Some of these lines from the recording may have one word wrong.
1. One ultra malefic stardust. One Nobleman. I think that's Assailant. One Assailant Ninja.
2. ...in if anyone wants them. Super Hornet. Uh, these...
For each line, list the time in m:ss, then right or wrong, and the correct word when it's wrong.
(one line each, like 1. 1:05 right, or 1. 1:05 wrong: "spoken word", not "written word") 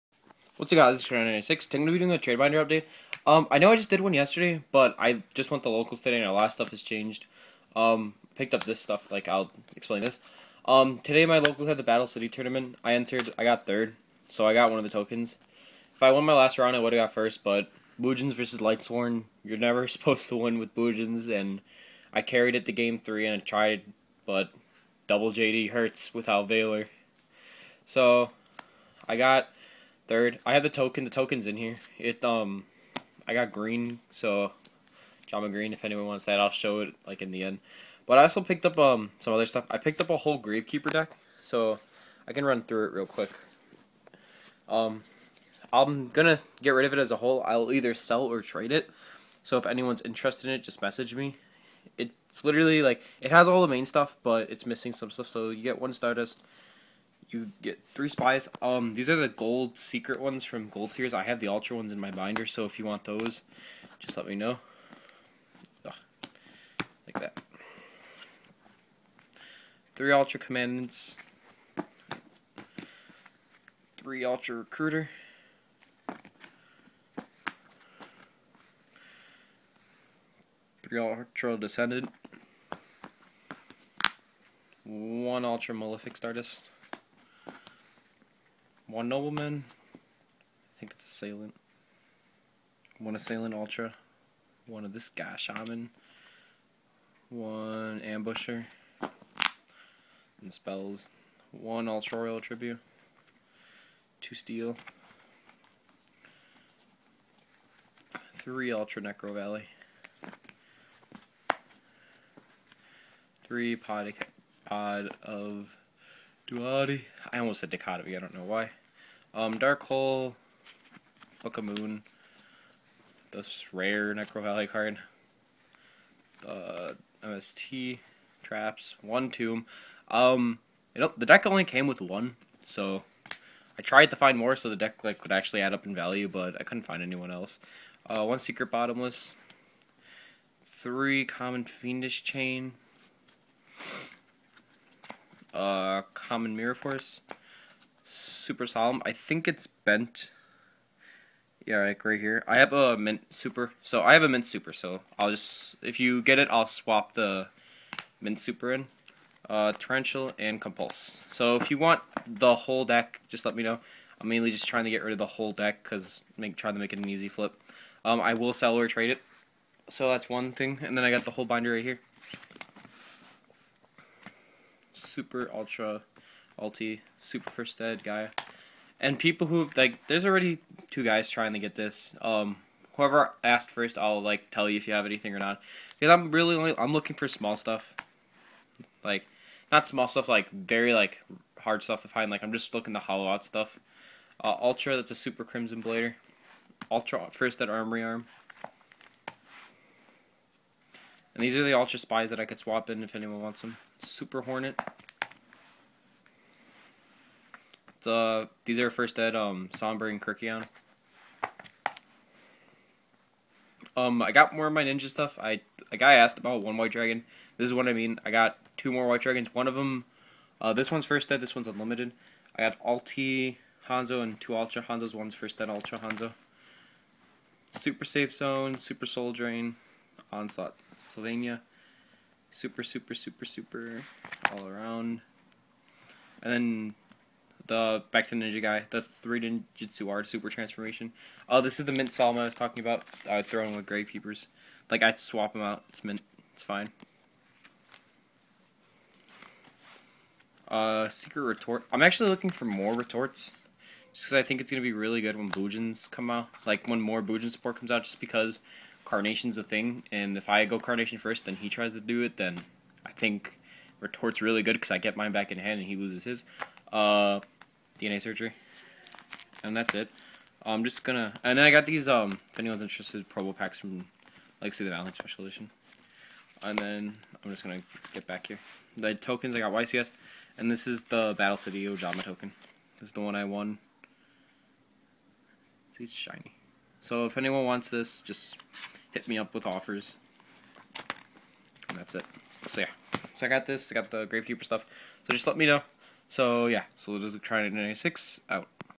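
1. 1:24 wrong: "Ultra", not "Ninja"
2. 3:22 right.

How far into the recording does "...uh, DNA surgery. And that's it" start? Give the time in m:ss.
4:26.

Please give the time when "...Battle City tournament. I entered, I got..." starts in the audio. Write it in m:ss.
0:11.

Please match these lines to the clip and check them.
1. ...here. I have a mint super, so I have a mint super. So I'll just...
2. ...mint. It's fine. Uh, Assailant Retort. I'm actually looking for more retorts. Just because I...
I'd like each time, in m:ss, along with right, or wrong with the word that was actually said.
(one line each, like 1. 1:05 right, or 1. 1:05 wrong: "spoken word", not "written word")
1. 2:32 right
2. 4:06 wrong: "Secret", not "Assailant".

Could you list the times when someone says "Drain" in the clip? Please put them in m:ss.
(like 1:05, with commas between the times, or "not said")
3:49.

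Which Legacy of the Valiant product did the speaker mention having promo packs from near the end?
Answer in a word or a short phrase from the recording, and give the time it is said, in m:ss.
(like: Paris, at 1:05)
Special Edition, at 4:35.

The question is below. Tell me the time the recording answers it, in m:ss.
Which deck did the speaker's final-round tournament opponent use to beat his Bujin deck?
0:18.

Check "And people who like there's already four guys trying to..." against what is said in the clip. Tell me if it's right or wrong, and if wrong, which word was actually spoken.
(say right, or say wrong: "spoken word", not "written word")
wrong: "two", not "four".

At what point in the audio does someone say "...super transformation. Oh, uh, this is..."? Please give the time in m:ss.
4:00.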